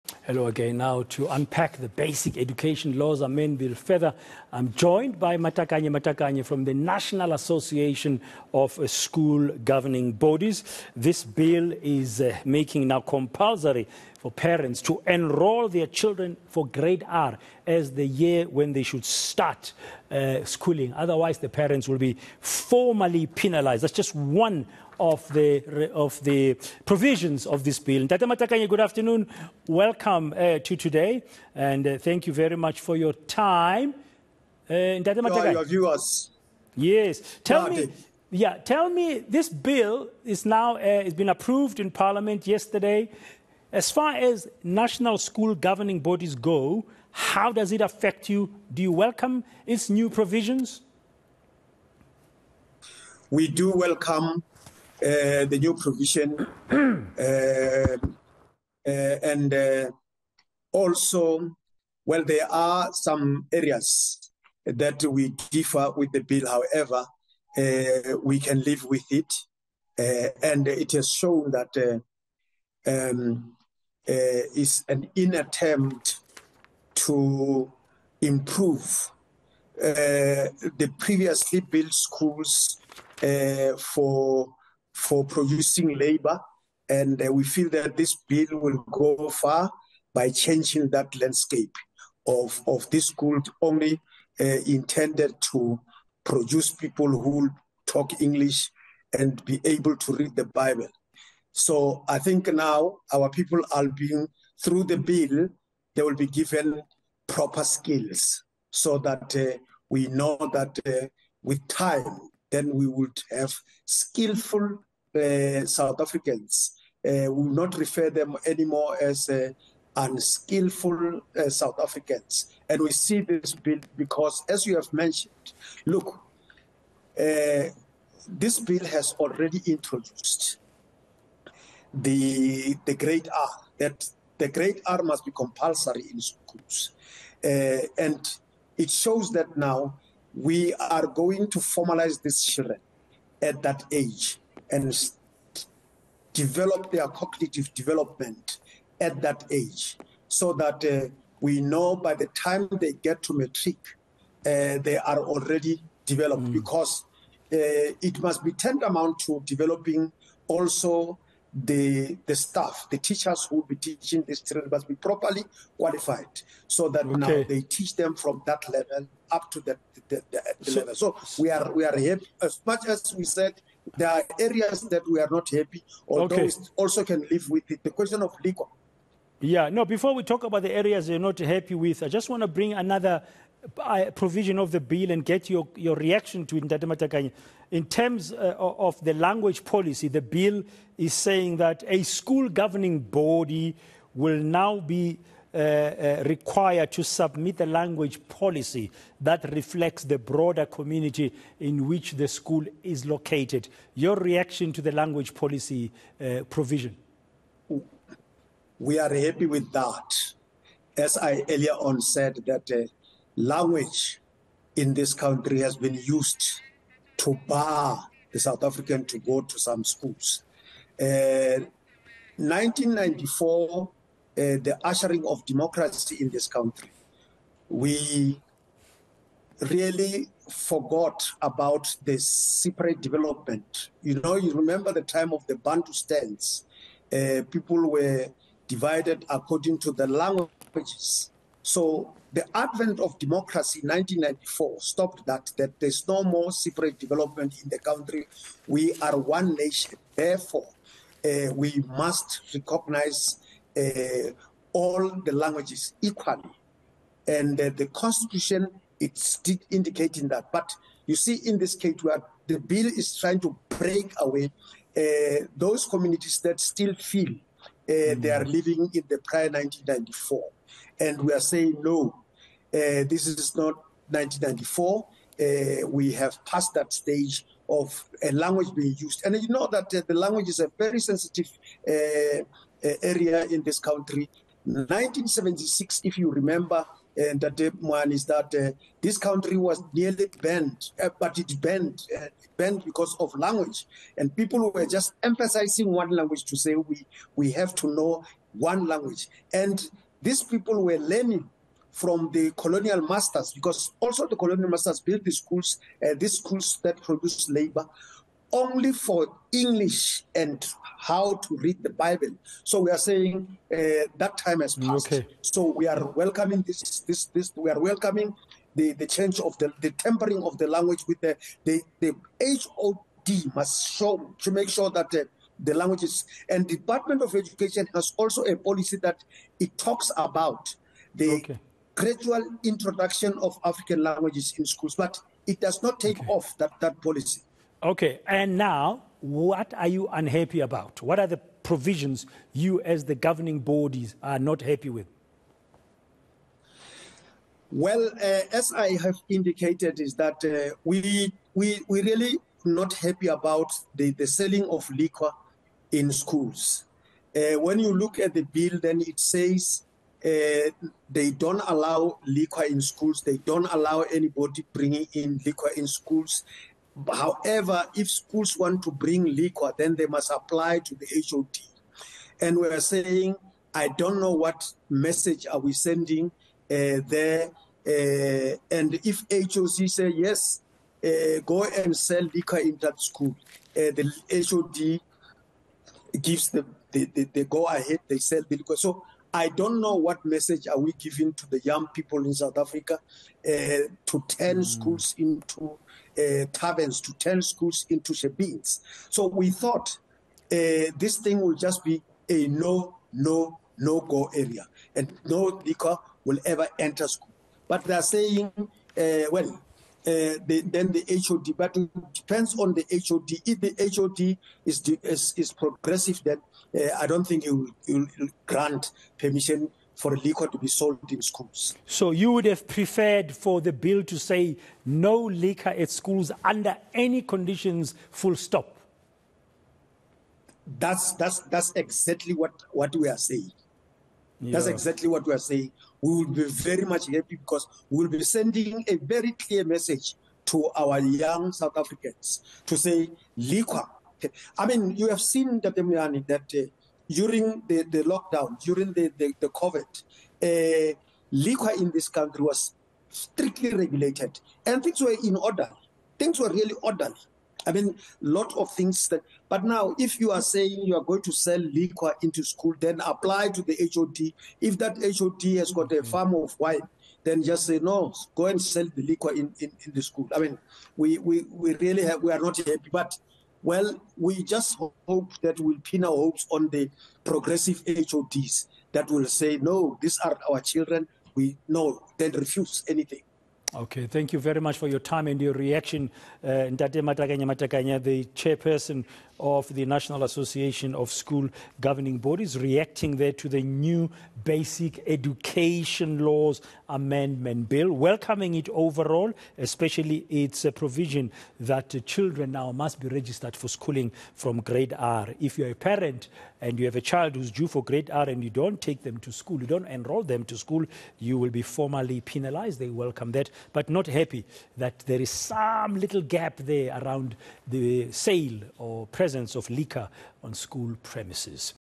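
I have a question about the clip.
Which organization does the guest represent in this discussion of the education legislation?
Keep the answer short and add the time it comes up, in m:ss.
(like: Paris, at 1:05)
National Association of School Governing Bodies, at 0:06.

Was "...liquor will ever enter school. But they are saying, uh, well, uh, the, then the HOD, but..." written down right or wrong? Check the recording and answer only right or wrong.
right.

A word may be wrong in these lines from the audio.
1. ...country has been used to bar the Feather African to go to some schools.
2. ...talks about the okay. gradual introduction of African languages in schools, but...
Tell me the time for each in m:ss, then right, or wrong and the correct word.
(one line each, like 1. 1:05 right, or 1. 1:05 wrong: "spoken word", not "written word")
1. 3:35 wrong: "South", not "Feather"
2. 5:29 right.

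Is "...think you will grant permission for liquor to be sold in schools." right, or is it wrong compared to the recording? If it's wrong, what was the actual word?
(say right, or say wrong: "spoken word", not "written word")
right.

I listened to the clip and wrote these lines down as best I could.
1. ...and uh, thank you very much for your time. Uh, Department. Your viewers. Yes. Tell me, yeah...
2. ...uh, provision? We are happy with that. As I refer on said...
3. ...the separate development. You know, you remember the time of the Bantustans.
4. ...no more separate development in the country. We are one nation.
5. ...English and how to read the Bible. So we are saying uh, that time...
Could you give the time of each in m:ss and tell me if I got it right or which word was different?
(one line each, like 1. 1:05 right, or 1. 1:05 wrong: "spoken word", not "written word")
1. 0:31 wrong: "Matakanye", not "Department"
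2. 3:26 wrong: "earlier", not "refer"
3. 3:52 right
4. 4:06 right
5. 5:09 right.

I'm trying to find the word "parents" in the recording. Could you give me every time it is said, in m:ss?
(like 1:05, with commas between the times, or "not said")
0:14, 0:21, 8:25.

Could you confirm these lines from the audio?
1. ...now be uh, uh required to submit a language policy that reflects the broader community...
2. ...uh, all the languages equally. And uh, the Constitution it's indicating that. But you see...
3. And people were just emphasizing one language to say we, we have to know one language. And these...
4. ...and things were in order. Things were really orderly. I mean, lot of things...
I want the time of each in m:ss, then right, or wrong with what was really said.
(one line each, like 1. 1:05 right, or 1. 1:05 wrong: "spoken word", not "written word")
1. 3:14 right
2. 4:13 right
3. 4:54 right
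4. 7:34 right.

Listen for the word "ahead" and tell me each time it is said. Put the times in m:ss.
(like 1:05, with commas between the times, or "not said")
6:27.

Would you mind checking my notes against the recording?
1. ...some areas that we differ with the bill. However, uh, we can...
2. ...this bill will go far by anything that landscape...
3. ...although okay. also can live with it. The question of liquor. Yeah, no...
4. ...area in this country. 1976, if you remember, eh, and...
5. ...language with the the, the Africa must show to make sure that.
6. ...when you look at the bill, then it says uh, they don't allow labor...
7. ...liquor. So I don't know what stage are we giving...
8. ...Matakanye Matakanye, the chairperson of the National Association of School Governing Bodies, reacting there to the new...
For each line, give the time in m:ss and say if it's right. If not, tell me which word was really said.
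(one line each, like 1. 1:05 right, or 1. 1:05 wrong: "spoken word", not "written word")
1. 1:02 right
2. 1:27 wrong: "changing", not "anything"
3. 2:56 right
4. 4:43 right
5. 5:20 wrong: "HOD", not "Africa"
6. 5:57 wrong: "liquor", not "labor"
7. 6:28 wrong: "message", not "stage"
8. 8:07 right.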